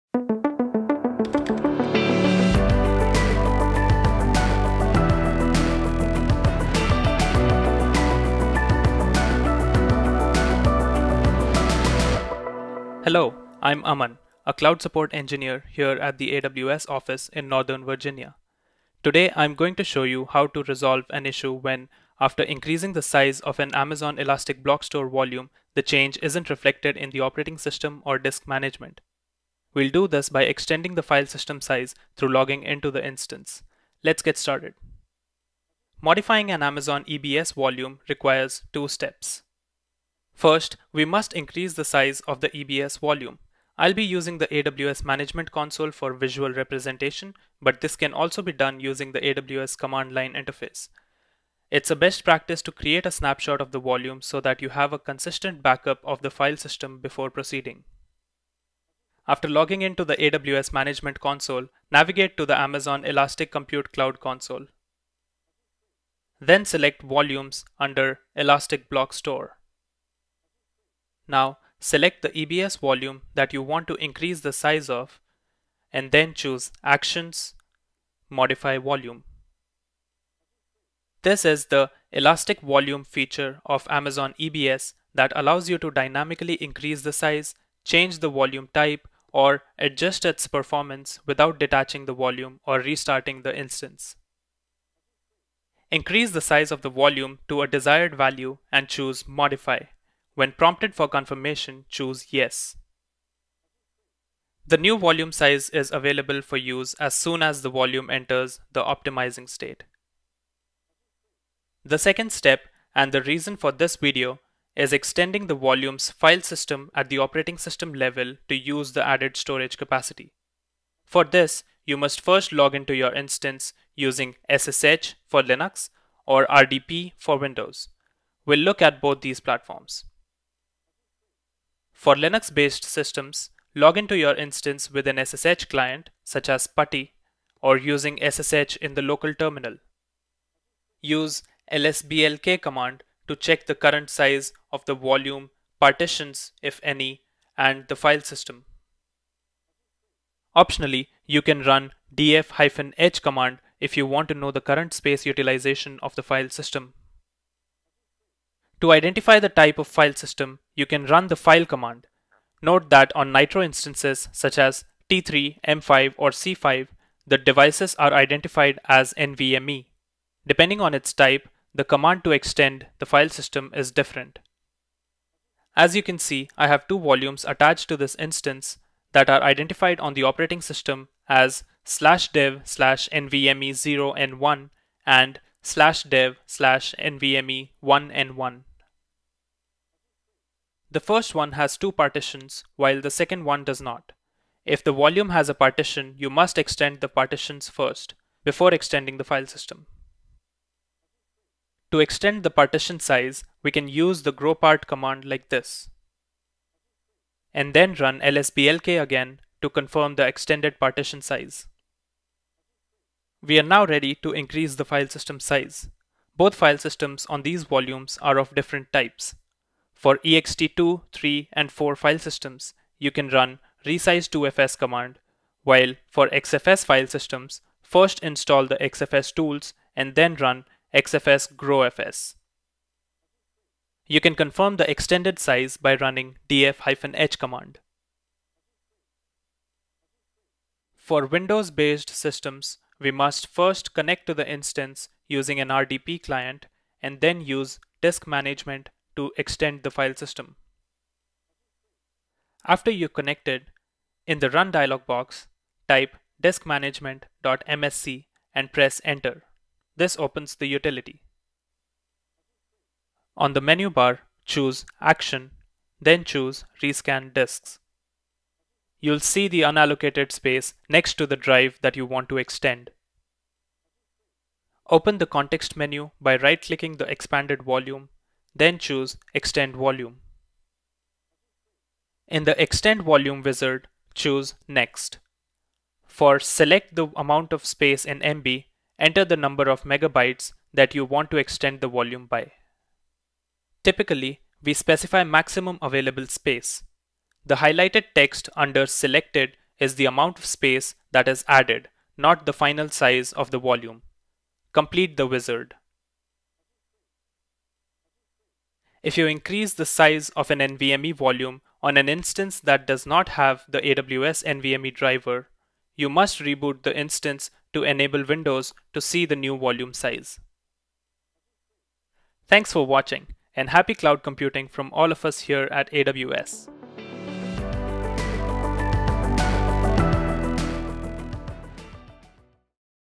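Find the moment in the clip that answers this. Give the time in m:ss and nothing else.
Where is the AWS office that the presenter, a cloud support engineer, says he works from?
0:17.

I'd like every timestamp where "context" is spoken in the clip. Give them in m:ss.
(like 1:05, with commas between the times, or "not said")
4:35.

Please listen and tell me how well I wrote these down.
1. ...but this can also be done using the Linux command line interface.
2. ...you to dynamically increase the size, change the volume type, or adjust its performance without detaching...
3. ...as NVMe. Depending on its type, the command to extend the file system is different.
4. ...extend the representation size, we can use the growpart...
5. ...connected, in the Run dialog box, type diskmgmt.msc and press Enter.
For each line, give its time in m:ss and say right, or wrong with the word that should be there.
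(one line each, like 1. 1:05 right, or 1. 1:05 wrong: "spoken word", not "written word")
1. 0:47 wrong: "AWS", not "Linux"
2. 1:25 right
3. 2:48 right
4. 3:22 wrong: "partition", not "representation"
5. 4:13 right.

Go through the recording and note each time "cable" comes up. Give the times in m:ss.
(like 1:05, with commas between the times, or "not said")
not said.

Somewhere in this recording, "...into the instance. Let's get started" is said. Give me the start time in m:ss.
0:32.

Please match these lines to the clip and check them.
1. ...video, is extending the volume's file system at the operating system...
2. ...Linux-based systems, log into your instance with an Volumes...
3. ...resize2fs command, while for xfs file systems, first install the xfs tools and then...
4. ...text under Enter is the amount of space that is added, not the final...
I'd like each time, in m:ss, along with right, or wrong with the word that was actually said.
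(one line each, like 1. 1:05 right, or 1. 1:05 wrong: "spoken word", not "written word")
1. 1:53 right
2. 2:12 wrong: "SSH", not "Volumes"
3. 3:43 right
4. 4:58 wrong: "Selected", not "Enter".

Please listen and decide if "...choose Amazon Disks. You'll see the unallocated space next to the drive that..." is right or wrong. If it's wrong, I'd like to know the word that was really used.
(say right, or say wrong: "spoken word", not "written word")
wrong: "Rescan", not "Amazon".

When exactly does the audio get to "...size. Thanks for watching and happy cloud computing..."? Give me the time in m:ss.
5:19.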